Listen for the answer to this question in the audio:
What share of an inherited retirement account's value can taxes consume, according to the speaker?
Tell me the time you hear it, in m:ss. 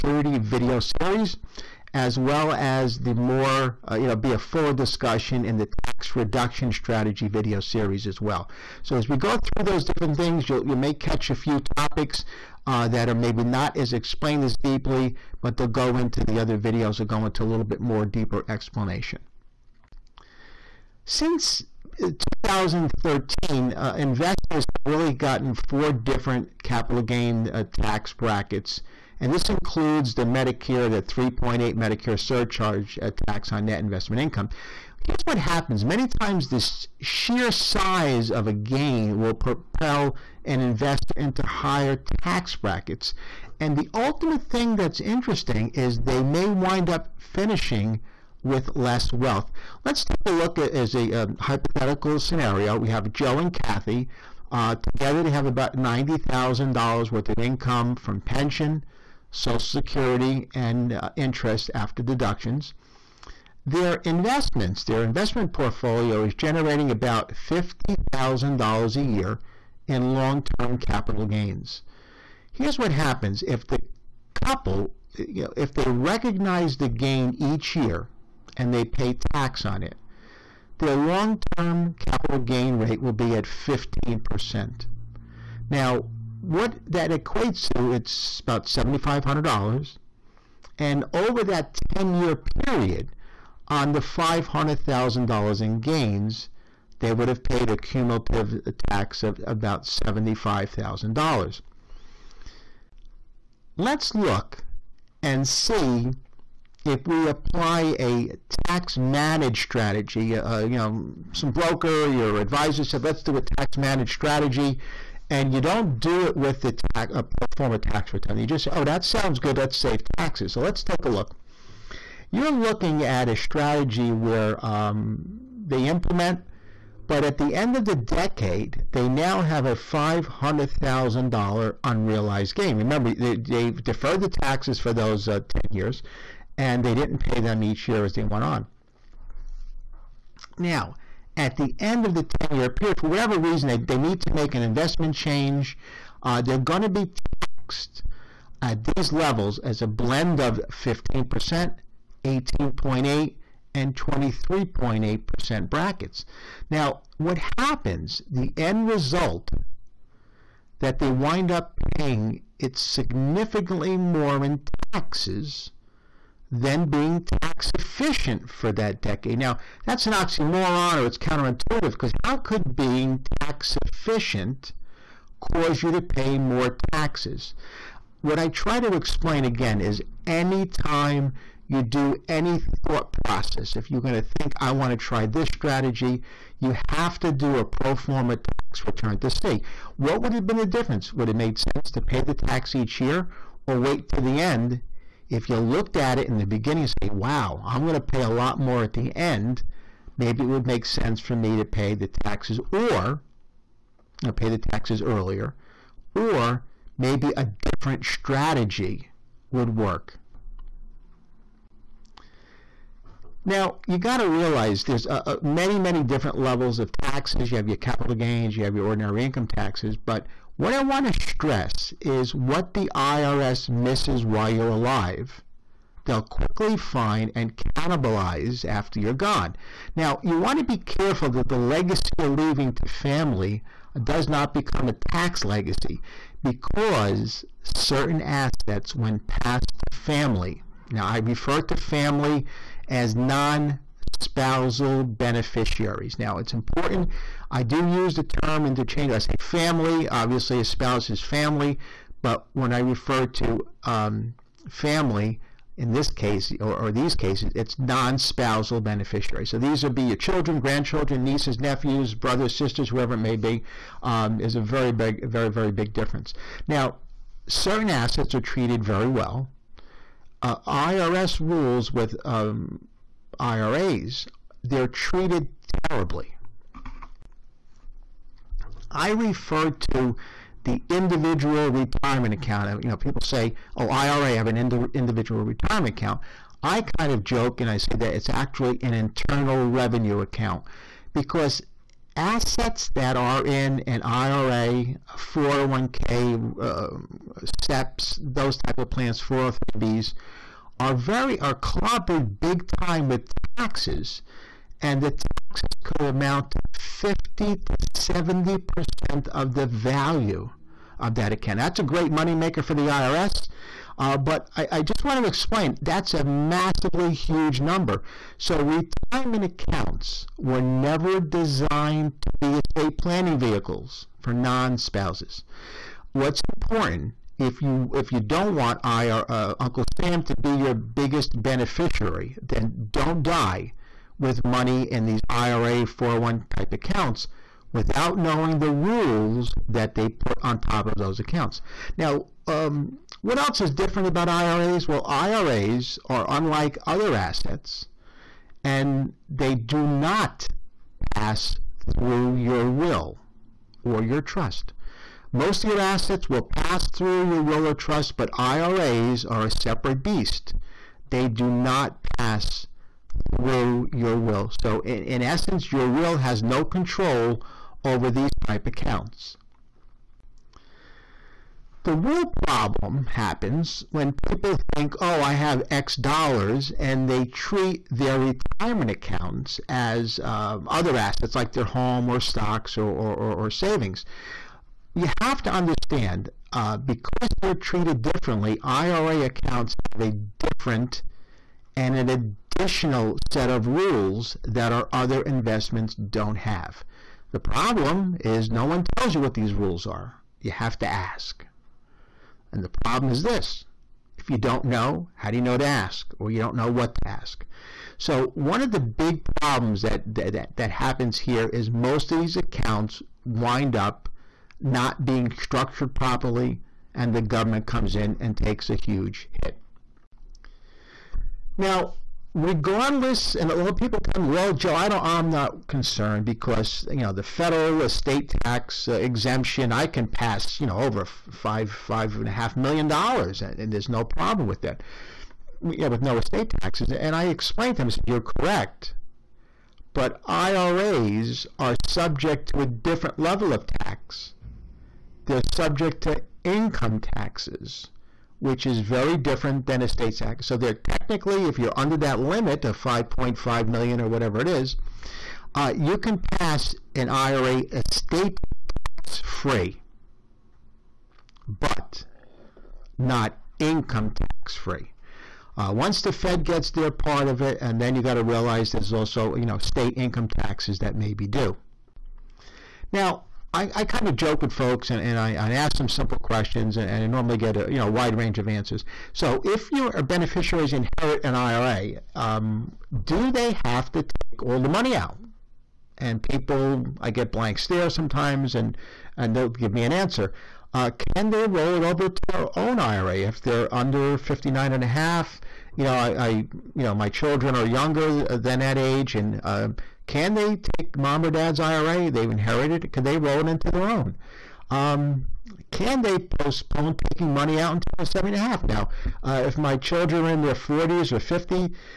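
5:06.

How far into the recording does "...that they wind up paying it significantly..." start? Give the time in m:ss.
2:40.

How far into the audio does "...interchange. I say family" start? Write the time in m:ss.
4:08.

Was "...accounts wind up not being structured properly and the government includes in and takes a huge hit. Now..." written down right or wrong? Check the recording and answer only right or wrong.
wrong.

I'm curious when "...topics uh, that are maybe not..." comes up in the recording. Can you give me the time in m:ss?
0:11.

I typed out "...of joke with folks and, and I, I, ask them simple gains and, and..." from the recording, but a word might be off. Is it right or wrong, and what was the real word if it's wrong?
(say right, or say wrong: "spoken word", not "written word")
wrong: "questions", not "gains".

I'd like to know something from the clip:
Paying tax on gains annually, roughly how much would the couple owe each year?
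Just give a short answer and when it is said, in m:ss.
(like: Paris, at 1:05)
$7,500, at 1:28.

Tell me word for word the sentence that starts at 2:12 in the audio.
Remember, they, have deferred the taxes for those uh, 10 years, and they didn't pay them each year as they went on.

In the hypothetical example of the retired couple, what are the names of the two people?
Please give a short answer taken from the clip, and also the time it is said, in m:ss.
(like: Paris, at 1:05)
Joe and Kathy, at 0:53.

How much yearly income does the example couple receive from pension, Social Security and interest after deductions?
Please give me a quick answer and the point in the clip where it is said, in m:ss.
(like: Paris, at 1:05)
$90,000, at 0:55.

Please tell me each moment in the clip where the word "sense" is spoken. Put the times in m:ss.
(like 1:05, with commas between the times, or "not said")
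3:11, 3:20.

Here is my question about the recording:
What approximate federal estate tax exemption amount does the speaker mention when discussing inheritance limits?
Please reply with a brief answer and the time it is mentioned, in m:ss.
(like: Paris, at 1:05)
5.5 million, at 7:32.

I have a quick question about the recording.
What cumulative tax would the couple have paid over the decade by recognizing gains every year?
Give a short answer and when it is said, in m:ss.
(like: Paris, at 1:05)
$75,000, at 1:39.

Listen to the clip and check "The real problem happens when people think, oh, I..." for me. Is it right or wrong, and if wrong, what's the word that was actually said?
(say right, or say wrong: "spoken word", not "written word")
right.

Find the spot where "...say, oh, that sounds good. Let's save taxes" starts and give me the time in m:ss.
1:58.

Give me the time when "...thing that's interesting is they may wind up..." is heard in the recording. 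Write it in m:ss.
0:44.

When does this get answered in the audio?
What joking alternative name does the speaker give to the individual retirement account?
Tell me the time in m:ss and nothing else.
4:48.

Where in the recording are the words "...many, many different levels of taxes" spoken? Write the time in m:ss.
3:35.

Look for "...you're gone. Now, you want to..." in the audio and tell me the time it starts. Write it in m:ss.
3:48.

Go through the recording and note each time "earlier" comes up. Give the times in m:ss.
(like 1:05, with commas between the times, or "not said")
3:25.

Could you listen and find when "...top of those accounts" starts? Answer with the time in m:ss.
5:40.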